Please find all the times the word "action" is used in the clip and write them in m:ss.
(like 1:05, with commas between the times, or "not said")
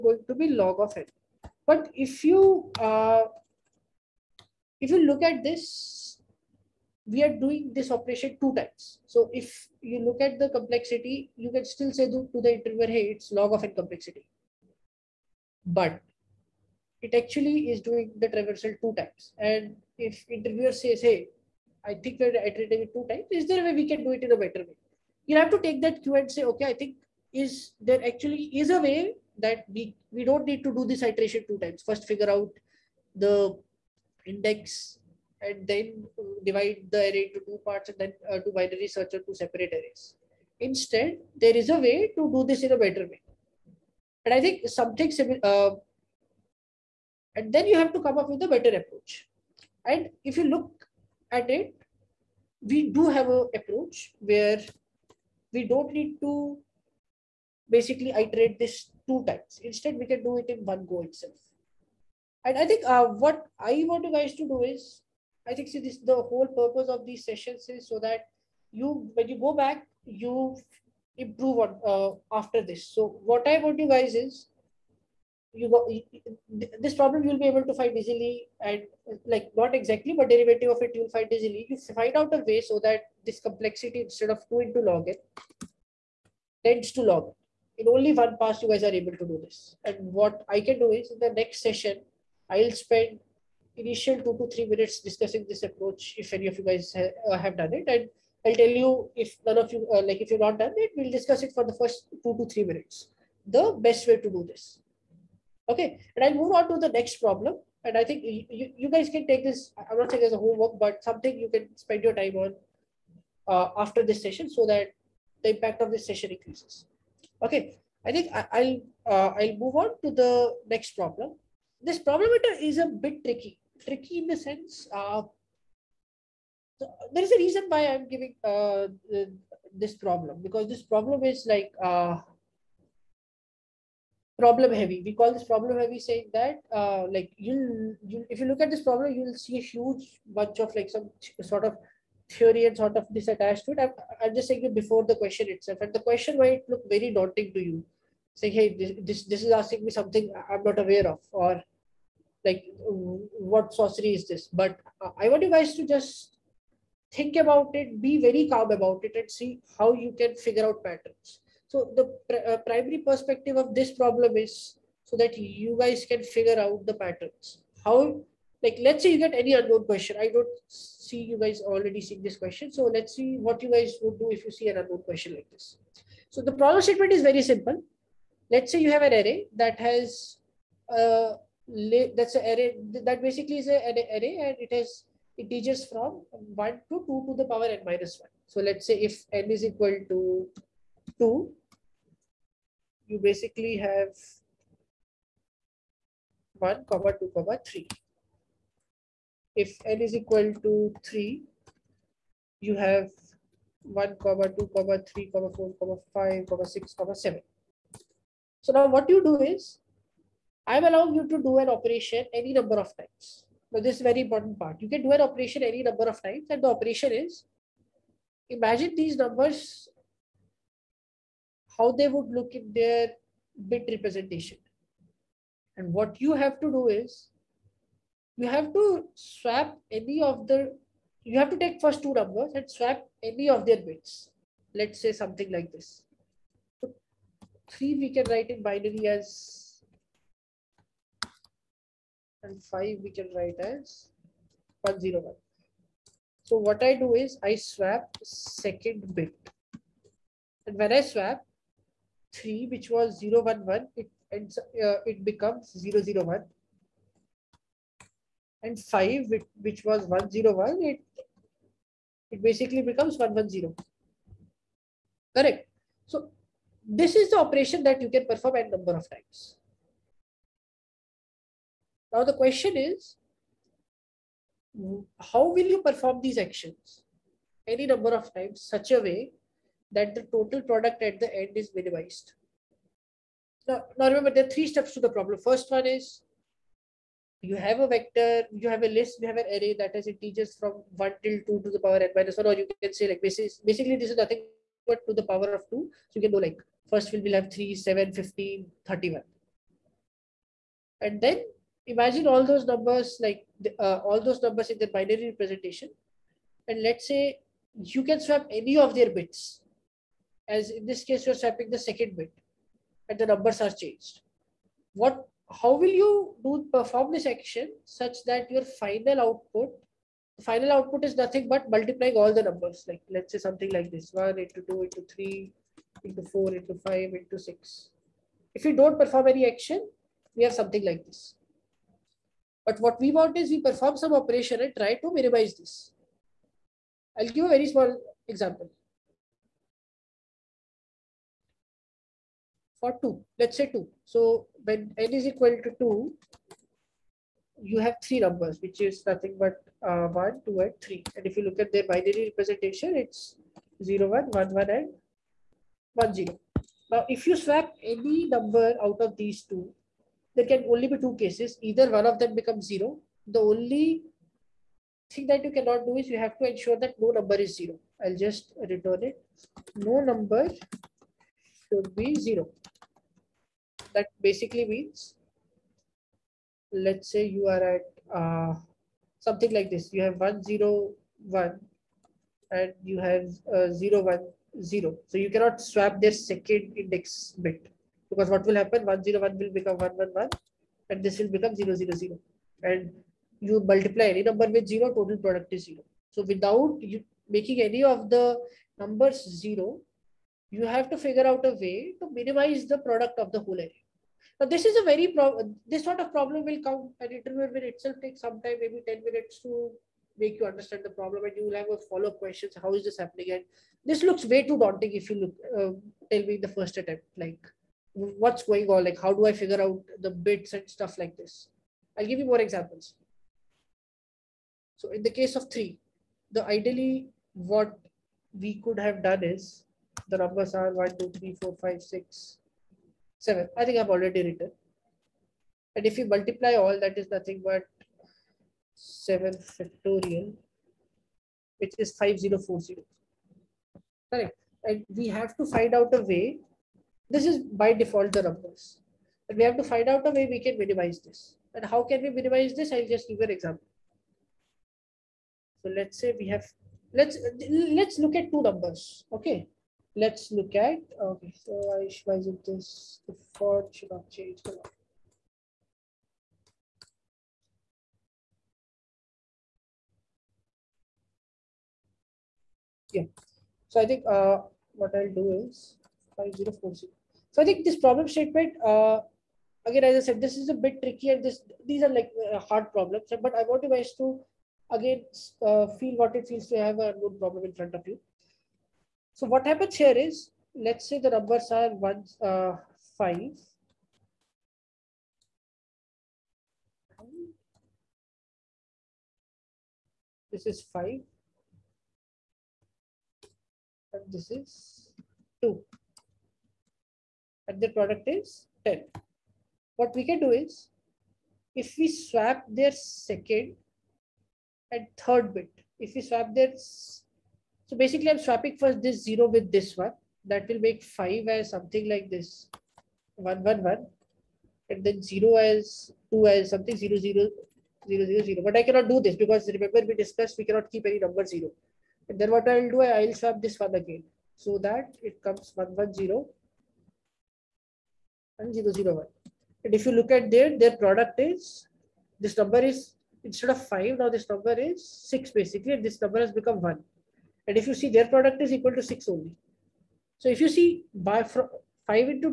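4:36, 5:17, 5:29.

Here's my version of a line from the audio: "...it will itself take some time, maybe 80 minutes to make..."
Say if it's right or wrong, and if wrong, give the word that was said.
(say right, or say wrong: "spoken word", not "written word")
wrong: "10", not "80".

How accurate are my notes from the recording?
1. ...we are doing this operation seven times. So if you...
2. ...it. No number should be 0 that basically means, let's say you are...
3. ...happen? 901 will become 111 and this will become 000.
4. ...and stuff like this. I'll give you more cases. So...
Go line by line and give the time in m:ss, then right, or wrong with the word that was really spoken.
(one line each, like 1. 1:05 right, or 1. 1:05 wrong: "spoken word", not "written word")
1. 0:07 wrong: "two", not "seven"
2. 6:09 right
3. 6:28 wrong: "101", not "901"
4. 7:00 wrong: "examples", not "cases".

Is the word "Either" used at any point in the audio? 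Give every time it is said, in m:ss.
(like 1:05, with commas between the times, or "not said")
6:01.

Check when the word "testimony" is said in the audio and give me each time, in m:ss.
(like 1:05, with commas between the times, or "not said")
not said.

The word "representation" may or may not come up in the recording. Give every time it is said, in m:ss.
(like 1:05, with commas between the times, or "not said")
3:43, 5:05, 5:52.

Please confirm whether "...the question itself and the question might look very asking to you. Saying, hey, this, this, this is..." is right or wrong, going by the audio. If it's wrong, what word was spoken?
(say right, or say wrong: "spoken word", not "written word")
wrong: "daunting", not "asking".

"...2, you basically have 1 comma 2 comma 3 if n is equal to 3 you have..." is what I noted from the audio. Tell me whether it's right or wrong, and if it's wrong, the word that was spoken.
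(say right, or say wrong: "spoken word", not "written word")
right.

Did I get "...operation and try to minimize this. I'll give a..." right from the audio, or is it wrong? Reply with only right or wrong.
right.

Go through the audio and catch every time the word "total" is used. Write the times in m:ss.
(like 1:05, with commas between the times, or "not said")
4:40, 6:34.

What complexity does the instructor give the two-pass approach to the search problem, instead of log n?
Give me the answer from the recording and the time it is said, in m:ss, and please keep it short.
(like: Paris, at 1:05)
2 into log n, at 1:24.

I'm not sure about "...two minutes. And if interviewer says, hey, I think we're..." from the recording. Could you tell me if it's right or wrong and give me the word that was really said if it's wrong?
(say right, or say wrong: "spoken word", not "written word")
wrong: "times", not "minutes".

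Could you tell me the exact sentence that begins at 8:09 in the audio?
So what happens here is, let's say the numbers are one, uh, five.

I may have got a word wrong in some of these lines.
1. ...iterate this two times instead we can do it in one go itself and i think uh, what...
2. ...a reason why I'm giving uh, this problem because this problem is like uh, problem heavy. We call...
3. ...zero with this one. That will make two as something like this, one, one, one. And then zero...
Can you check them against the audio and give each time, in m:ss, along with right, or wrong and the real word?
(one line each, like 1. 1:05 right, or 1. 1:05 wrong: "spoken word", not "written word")
1. 0:58 right
2. 2:07 right
3. 8:39 wrong: "five", not "two".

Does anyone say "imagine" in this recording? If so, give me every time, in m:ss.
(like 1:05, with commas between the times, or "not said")
3:38, 5:01.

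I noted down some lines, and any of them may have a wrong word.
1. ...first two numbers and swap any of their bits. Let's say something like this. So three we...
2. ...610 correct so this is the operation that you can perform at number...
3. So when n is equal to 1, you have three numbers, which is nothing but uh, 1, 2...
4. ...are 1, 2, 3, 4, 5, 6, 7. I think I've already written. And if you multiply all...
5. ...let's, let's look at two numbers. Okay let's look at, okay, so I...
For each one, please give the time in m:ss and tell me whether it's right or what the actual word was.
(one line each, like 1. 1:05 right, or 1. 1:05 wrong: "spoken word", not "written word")
1. 3:51 right
2. 4:23 wrong: "110", not "610"
3. 5:44 wrong: "2", not "1"
4. 7:10 right
5. 7:36 right.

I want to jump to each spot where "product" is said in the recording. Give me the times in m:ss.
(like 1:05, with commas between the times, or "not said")
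4:40, 6:35, 6:42, 8:27, 9:00, 9:08.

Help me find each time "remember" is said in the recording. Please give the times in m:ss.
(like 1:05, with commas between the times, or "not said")
4:44, 8:49.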